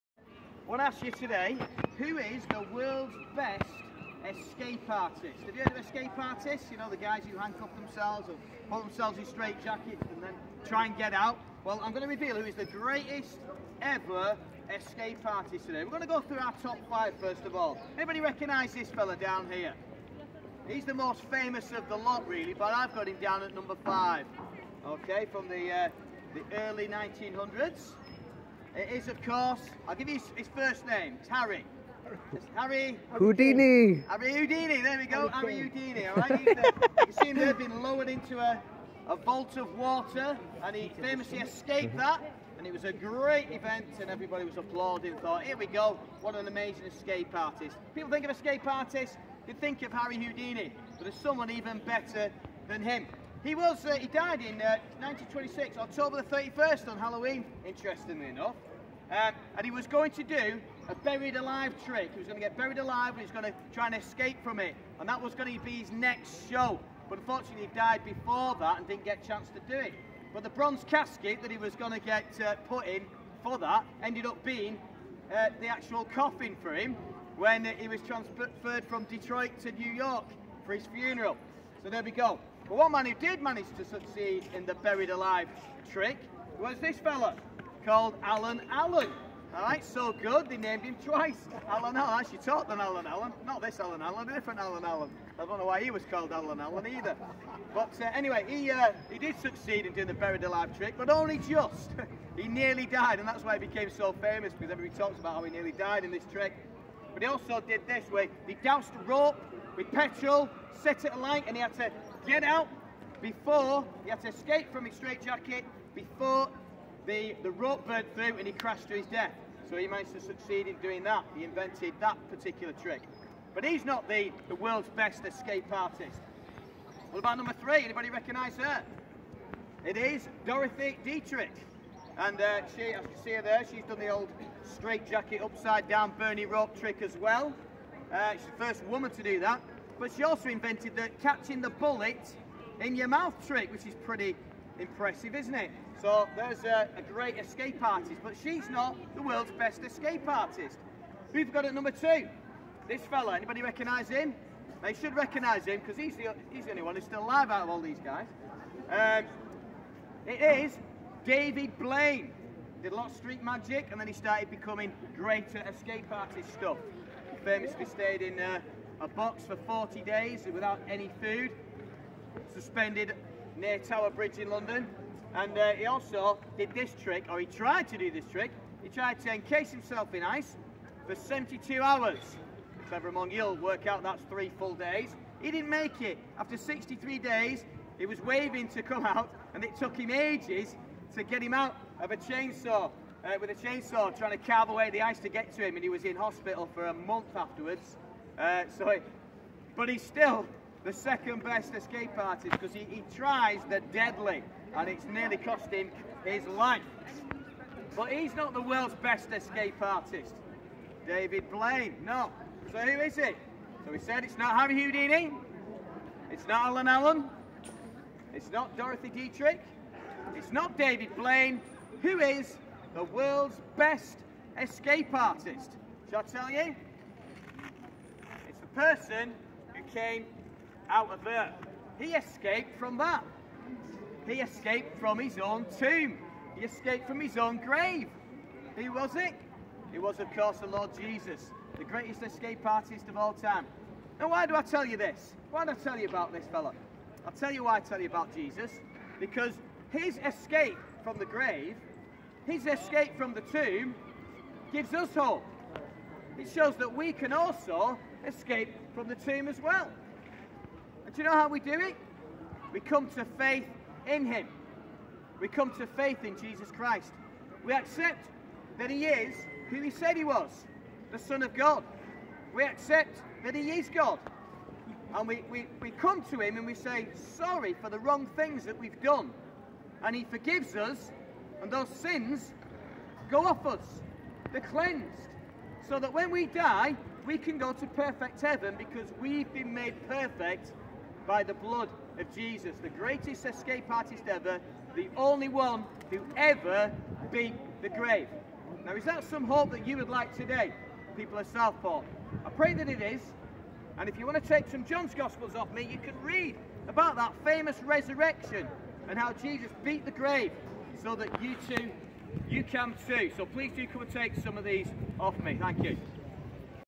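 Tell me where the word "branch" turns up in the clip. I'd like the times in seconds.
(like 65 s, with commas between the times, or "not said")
not said.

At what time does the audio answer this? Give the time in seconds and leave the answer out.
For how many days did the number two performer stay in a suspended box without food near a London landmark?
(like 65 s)
169 s.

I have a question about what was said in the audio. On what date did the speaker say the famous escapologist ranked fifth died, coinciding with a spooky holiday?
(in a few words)
October 31st.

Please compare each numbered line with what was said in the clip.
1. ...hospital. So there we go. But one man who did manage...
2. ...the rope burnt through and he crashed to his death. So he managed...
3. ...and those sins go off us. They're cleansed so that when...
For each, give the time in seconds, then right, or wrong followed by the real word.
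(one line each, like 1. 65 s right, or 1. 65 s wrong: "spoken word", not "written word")
1. 80 s wrong: "funeral", not "hospital"
2. 117 s right
3. 281 s right.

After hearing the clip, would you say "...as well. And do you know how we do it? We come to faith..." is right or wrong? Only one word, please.
right.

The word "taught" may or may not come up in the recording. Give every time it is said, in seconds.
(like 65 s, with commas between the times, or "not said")
92 s.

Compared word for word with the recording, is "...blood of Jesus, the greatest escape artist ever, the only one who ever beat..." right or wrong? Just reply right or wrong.
right.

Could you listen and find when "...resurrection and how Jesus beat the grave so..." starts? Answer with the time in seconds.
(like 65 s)
307 s.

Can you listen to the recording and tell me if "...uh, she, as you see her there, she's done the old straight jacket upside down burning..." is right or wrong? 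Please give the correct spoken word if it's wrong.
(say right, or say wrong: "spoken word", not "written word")
right.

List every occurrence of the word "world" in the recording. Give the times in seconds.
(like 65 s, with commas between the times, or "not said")
2 s, 124 s, 149 s, 208 s, 223 s.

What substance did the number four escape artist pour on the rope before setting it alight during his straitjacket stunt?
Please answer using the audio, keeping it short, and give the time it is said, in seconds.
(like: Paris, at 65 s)
petrol, at 109 s.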